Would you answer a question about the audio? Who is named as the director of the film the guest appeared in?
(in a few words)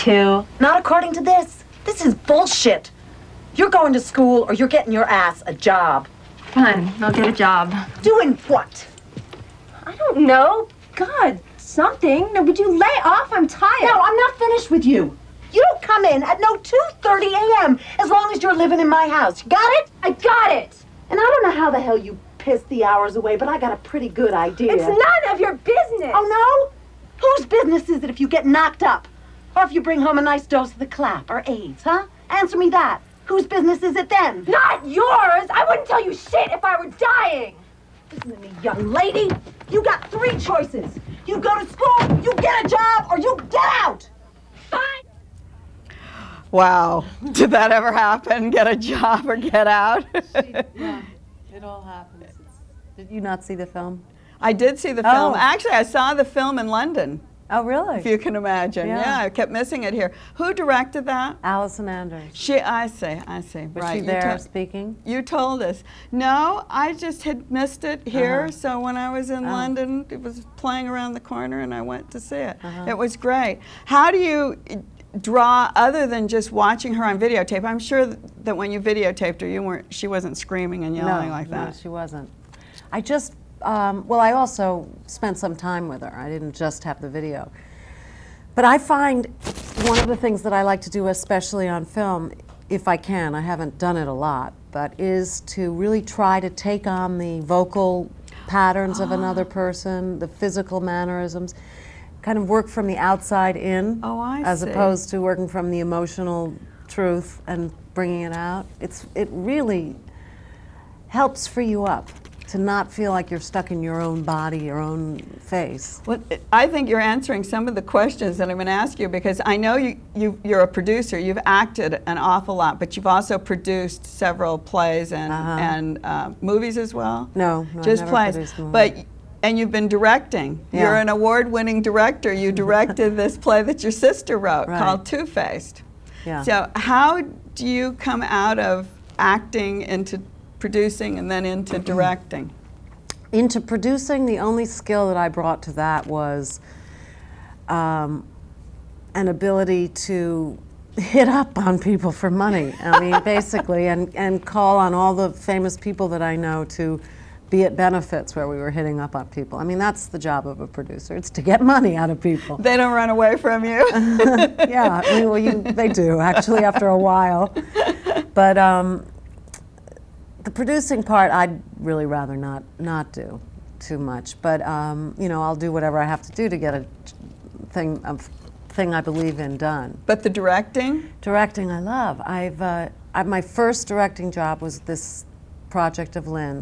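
Allison Anders.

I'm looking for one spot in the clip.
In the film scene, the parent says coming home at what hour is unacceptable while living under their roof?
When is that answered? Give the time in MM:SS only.
00:16.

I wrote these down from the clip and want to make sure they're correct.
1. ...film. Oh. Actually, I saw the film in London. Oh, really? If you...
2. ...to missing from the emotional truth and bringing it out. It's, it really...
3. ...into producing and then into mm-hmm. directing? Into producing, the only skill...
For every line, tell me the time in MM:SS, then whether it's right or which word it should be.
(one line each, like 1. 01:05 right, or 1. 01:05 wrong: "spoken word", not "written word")
1. 00:55 right
2. 01:45 wrong: "working", not "missing"
3. 02:19 right.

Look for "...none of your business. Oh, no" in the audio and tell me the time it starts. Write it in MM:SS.
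00:24.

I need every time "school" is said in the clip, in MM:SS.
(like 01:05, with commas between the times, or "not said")
00:04, 00:41.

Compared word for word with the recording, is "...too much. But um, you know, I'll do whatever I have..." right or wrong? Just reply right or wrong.
right.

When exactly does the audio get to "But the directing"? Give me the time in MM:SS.
03:00.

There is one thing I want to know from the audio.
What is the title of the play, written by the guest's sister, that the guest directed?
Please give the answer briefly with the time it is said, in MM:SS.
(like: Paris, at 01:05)
Two Faced, at 02:15.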